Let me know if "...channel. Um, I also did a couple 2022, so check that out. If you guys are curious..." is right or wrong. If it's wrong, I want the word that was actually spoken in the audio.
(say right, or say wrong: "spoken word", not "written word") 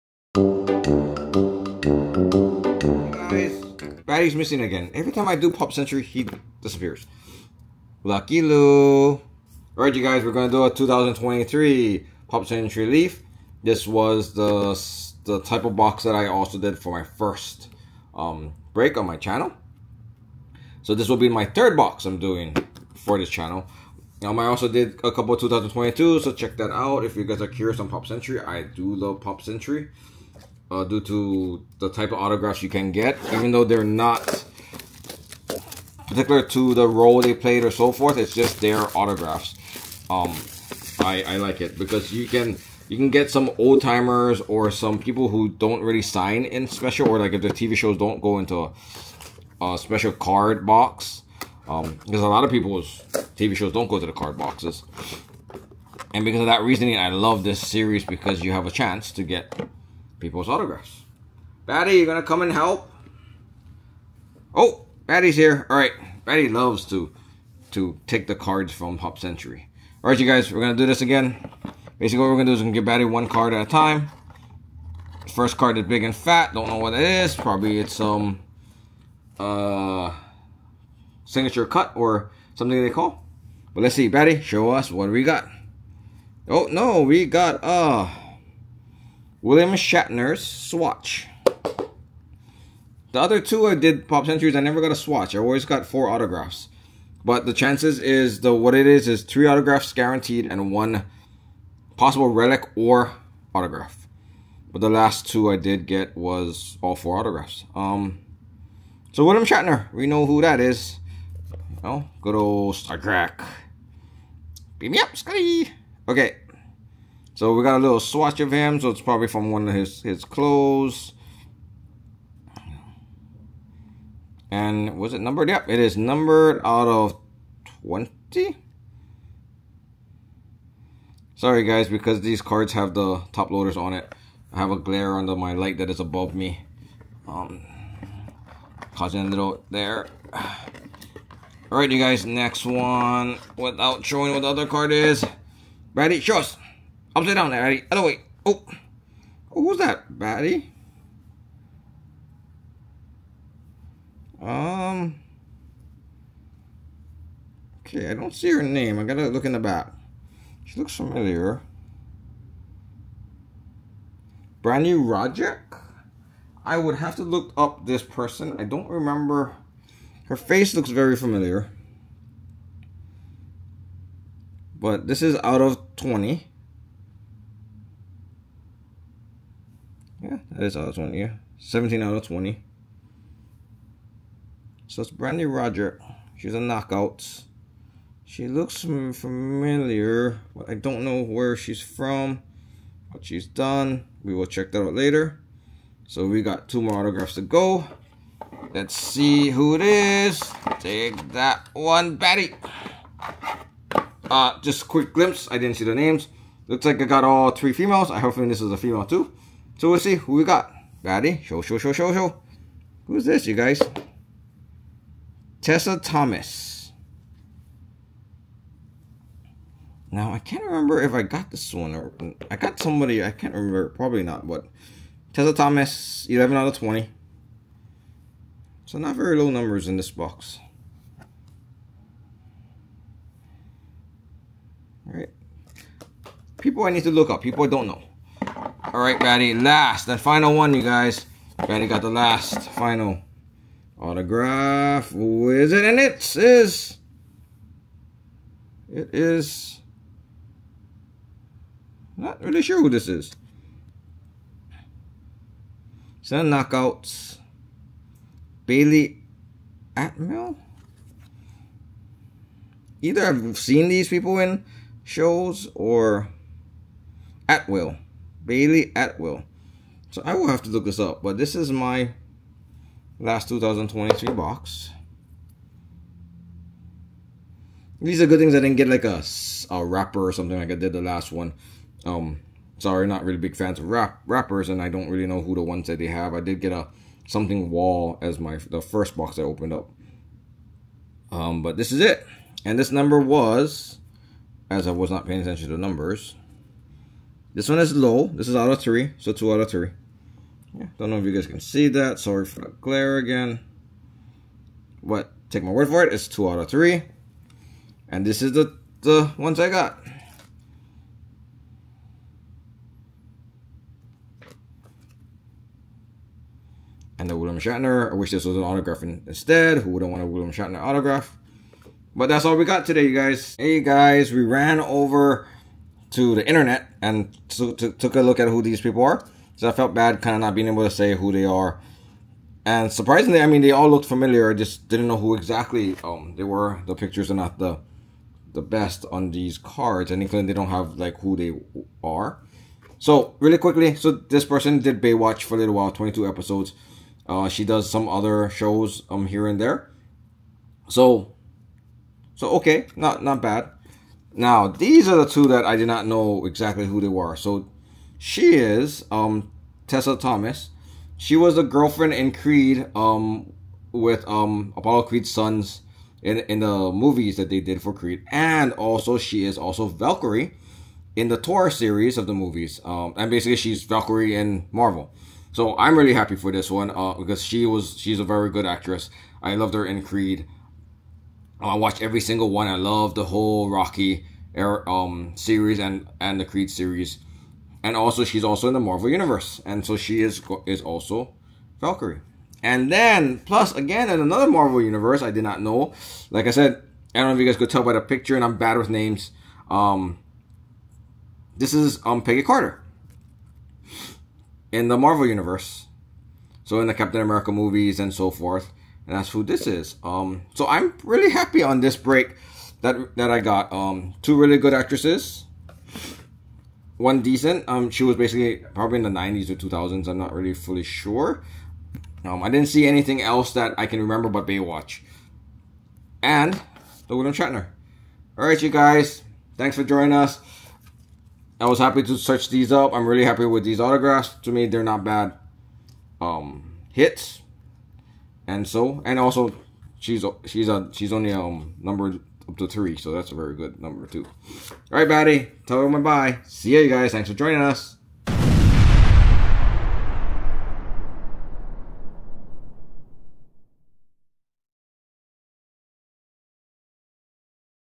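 right.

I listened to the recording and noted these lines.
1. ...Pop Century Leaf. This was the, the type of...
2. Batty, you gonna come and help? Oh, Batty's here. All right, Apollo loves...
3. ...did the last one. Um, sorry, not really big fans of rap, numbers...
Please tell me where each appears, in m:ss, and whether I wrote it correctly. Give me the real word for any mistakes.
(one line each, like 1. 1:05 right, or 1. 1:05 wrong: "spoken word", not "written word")
1. 0:12 right
2. 1:01 wrong: "Batty", not "Apollo"
3. 4:40 wrong: "rappers", not "numbers".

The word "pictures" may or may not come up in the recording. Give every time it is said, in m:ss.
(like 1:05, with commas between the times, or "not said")
5:36, 6:38.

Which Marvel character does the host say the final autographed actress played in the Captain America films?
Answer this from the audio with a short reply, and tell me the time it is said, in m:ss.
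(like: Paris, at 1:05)
Peggy Carter, at 6:42.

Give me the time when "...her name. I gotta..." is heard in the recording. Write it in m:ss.
2:38.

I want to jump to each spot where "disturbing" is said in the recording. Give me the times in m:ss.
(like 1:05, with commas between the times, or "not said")
not said.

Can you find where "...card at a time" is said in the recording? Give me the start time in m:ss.
1:13.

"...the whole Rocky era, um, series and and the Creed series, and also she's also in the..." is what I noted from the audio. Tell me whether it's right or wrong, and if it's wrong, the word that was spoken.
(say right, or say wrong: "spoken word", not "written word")
right.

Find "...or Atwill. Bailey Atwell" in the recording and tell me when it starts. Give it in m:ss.
4:25.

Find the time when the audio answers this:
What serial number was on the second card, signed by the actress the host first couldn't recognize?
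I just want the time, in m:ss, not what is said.
3:01.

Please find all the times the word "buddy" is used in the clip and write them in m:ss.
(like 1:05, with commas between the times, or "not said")
7:25.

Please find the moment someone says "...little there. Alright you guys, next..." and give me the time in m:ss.
2:19.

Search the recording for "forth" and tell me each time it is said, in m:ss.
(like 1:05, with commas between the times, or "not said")
0:37, 6:48.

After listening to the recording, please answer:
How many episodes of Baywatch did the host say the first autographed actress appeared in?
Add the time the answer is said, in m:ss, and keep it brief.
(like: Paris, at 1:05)
22, at 5:45.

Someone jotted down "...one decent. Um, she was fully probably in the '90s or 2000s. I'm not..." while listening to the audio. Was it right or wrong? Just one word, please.
wrong.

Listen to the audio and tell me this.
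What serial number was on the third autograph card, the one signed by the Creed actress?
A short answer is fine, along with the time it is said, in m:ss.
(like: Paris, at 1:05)
11, at 3:46.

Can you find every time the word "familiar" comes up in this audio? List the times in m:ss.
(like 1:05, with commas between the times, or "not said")
2:40, 2:51, 3:08, 5:34.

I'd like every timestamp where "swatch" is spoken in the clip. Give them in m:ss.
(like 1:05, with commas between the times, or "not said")
1:30, 1:34, 1:57.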